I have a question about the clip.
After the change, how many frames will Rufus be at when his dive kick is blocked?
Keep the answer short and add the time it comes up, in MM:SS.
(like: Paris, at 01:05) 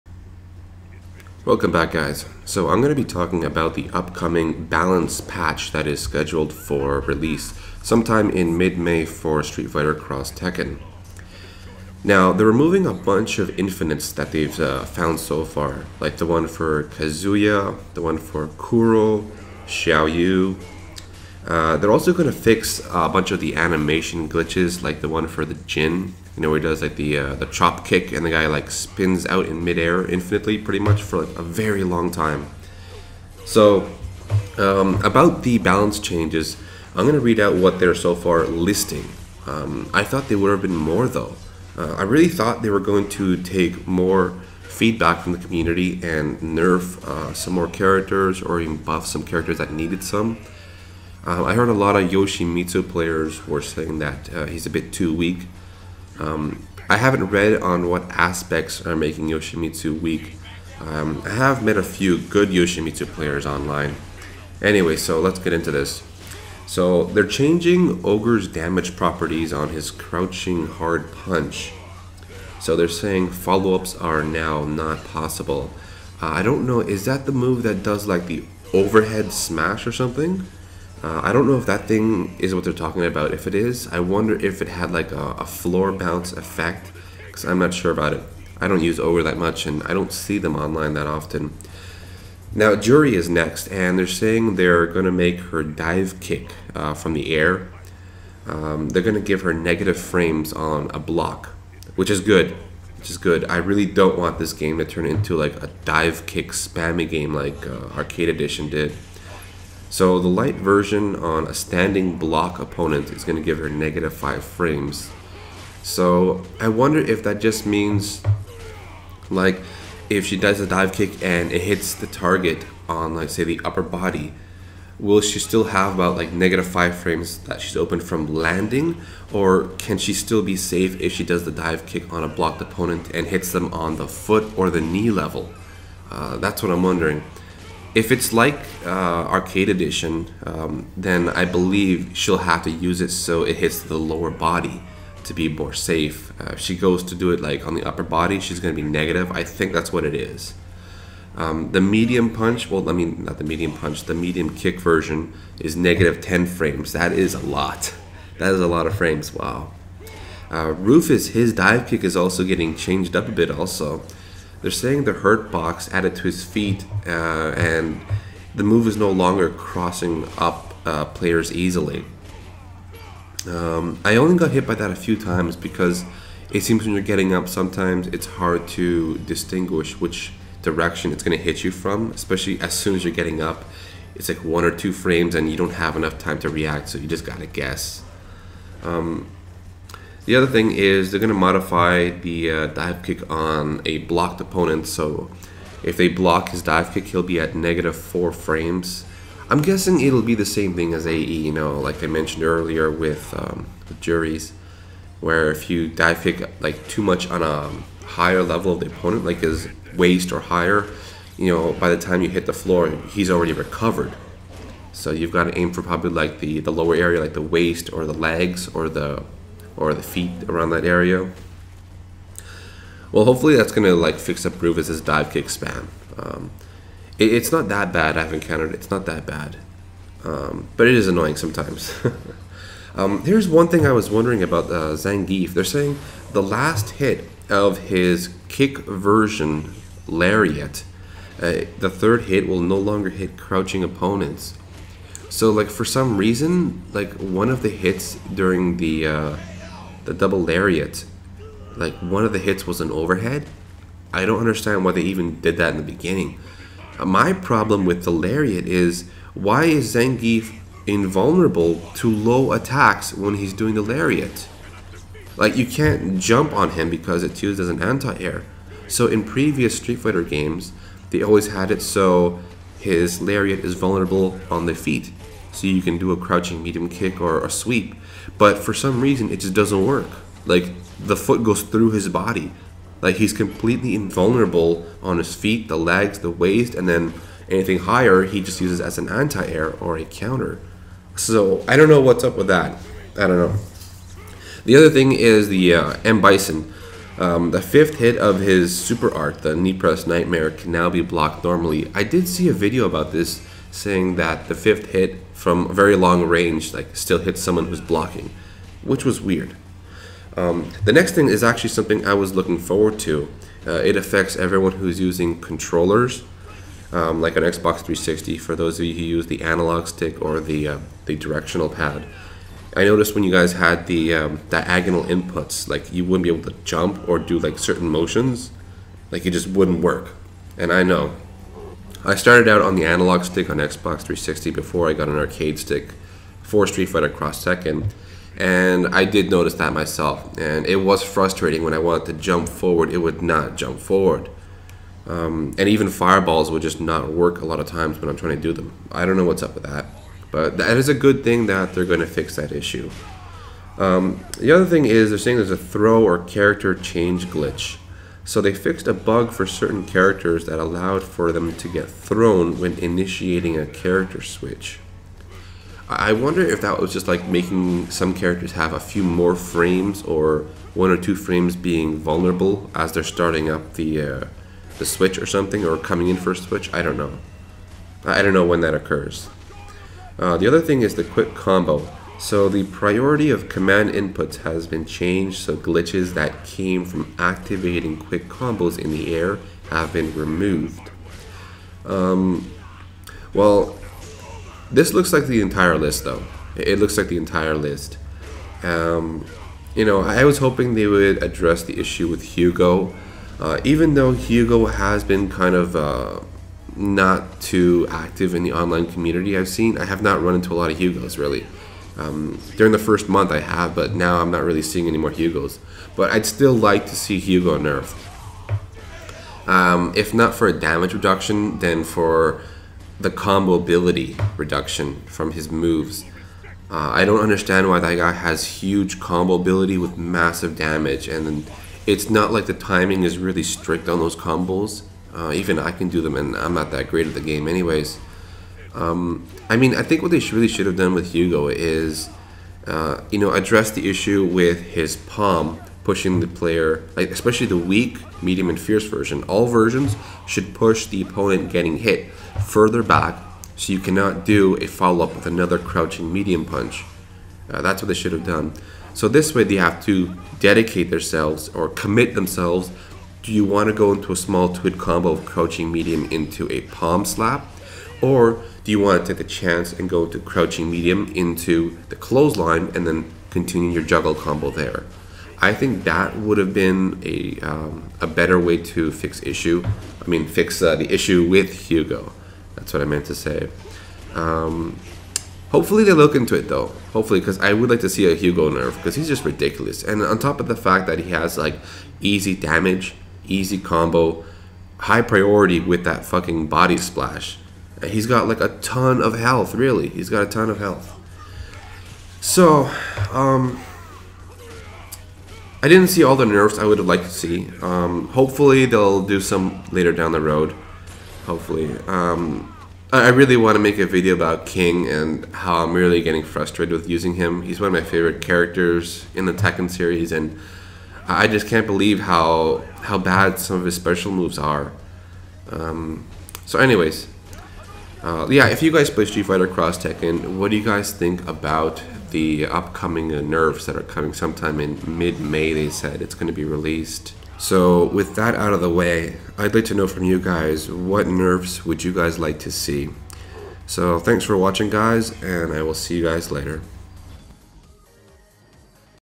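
-4, at 03:17.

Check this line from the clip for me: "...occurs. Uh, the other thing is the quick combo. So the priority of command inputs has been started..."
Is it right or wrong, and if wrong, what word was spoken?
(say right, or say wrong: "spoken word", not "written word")
wrong: "changed", not "started".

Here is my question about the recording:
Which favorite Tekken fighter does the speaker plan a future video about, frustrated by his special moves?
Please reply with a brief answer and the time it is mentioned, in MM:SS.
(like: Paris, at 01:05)
King, at 08:34.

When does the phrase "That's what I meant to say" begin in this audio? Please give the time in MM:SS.
08:02.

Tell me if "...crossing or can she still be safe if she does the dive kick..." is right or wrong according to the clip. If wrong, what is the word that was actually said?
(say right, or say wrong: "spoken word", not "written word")
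wrong: "landing", not "crossing".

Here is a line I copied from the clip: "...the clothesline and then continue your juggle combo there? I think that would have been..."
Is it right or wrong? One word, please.
right.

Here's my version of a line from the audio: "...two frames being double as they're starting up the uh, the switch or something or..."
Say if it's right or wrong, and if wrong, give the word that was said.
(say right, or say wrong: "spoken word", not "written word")
wrong: "vulnerable", not "double".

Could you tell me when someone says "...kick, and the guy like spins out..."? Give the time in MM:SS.
00:27.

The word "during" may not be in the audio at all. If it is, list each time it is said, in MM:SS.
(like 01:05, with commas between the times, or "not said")
04:08, 06:52.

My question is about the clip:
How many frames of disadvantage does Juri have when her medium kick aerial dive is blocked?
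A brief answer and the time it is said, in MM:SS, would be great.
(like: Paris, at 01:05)
-10, at 02:35.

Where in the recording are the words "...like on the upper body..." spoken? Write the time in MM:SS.
02:27.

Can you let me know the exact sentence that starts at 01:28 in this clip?
I don't use Ogre that much, and I don't see them online that often.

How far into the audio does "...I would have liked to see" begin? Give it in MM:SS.
08:26.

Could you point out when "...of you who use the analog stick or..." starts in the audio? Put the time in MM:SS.
05:18.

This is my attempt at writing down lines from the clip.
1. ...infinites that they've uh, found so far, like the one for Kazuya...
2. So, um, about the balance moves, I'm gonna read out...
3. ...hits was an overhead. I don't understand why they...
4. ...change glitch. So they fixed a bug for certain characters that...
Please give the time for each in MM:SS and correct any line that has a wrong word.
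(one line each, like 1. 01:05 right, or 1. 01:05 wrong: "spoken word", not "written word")
1. 00:13 right
2. 00:33 wrong: "changes", not "moves"
3. 04:12 right
4. 05:56 right.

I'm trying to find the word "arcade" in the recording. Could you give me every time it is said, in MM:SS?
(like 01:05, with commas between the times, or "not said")
01:47, 02:19, 05:35.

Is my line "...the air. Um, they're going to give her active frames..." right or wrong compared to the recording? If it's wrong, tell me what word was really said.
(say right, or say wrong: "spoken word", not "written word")
wrong: "negative", not "active".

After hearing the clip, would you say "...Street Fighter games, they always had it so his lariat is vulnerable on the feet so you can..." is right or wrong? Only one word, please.
right.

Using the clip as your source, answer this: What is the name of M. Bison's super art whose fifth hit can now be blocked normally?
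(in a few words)
Knee Press Nightmare.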